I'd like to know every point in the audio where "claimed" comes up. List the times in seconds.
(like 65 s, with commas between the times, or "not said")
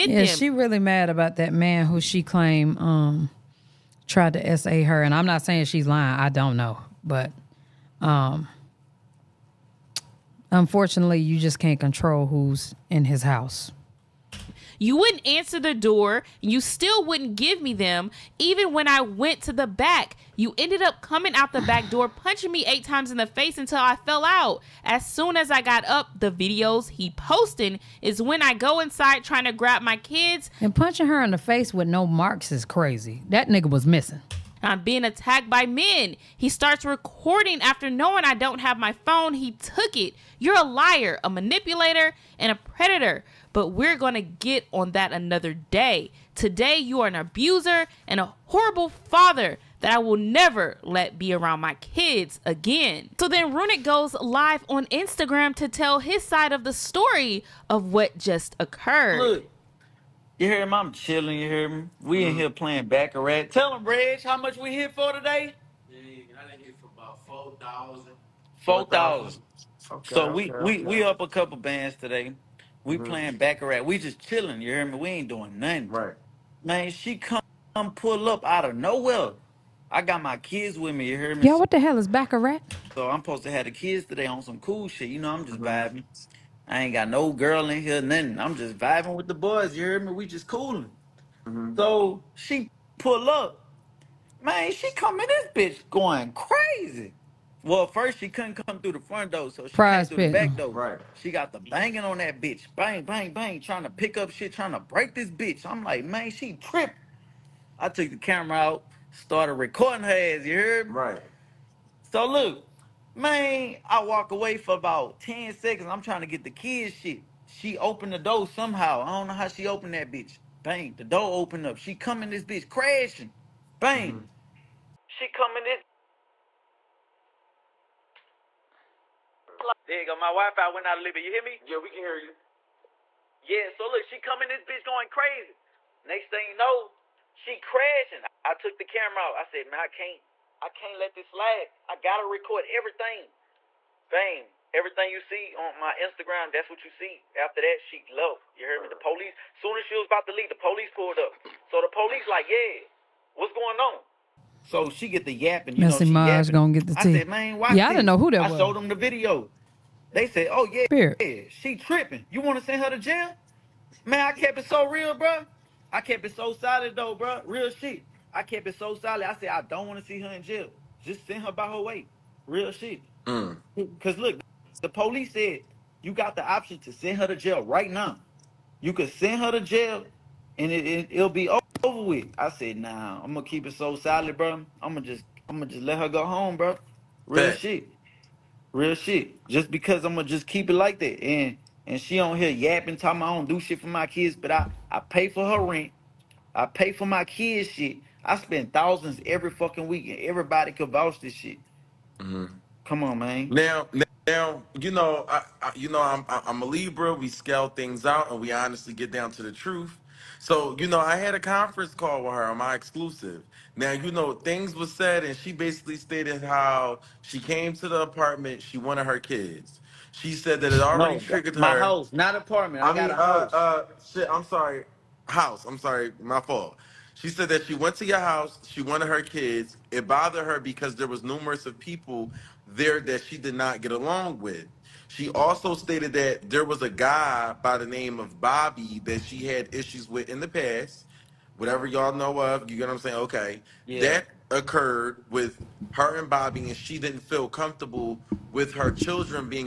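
2 s.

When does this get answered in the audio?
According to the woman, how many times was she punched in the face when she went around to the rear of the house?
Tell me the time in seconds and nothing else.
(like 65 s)
22 s.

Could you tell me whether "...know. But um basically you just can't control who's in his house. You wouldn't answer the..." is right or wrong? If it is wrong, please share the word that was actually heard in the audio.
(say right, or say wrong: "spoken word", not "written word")
wrong: "unfortunately", not "basically".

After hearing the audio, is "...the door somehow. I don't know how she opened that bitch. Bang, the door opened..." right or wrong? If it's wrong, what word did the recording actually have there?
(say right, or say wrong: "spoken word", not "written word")
right.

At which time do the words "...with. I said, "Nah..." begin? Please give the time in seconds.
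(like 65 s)
182 s.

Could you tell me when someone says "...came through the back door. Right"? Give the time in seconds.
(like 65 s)
100 s.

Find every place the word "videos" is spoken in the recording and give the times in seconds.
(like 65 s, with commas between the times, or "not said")
26 s, 158 s.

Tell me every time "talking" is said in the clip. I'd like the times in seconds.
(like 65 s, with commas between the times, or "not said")
192 s.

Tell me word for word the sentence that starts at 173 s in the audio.
Cause look, the police said you got the option to send her to jail right now.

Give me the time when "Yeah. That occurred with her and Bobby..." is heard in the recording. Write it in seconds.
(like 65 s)
243 s.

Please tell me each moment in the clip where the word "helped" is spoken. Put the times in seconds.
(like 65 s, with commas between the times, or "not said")
not said.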